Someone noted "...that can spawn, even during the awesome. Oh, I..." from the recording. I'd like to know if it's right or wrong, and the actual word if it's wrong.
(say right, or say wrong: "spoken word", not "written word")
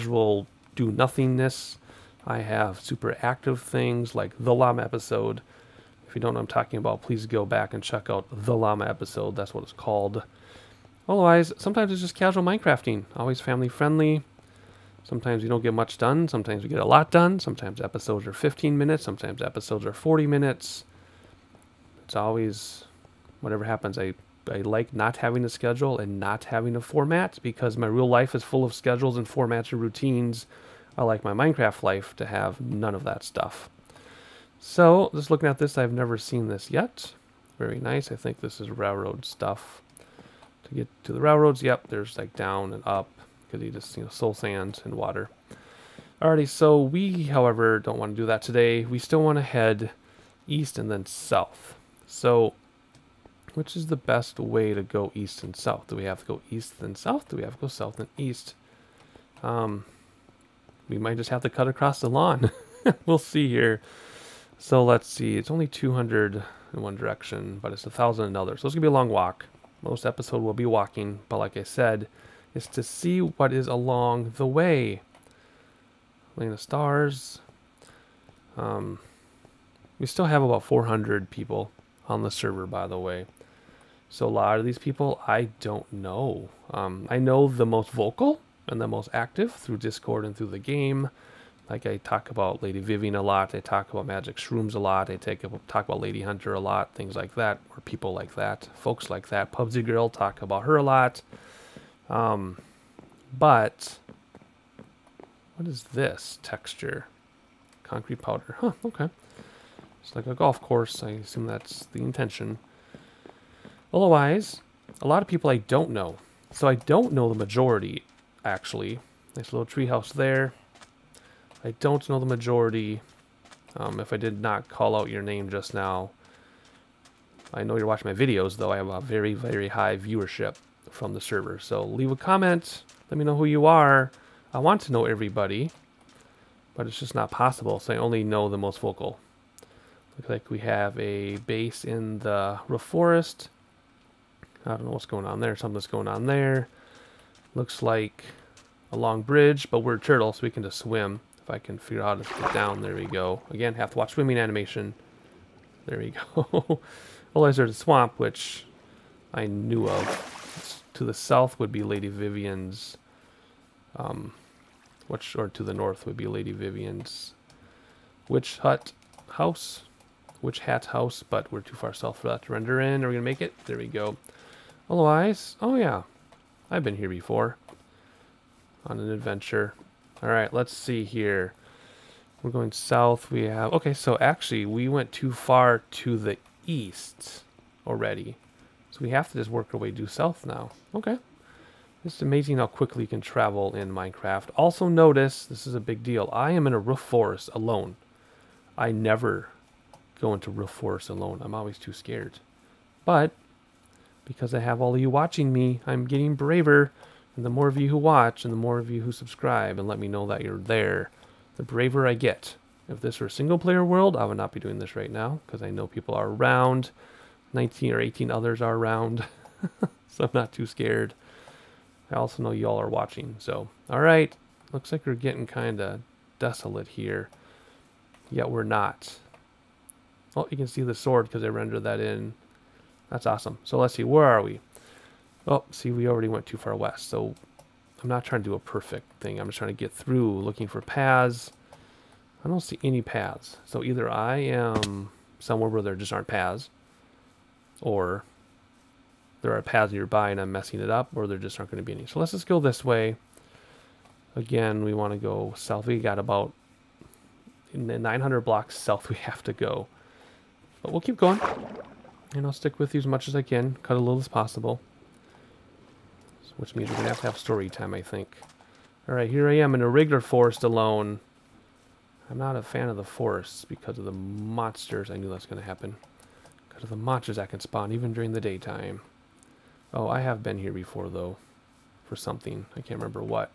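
wrong: "daytime", not "awesome".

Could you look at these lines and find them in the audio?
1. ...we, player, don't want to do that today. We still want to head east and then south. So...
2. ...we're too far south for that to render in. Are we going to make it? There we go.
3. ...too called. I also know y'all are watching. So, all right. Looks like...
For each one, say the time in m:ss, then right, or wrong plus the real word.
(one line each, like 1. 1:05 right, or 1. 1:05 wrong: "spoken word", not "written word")
1. 0:46 wrong: "however", not "player"
2. 2:51 right
3. 3:40 wrong: "scared", not "called".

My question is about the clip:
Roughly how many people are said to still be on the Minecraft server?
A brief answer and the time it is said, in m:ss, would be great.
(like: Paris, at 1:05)
400, at 1:20.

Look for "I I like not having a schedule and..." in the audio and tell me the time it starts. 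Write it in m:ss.
0:23.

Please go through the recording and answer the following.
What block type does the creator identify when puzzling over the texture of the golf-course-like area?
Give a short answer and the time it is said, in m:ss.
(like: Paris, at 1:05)
Concrete powder, at 1:47.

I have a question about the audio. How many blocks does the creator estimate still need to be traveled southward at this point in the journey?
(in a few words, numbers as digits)
900.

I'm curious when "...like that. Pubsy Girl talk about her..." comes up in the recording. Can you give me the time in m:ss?
1:39.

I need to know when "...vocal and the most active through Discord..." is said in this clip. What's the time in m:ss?
1:27.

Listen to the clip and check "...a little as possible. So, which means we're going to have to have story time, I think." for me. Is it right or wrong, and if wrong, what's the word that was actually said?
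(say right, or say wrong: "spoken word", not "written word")
right.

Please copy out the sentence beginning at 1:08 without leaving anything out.
So it's going to be a long walk.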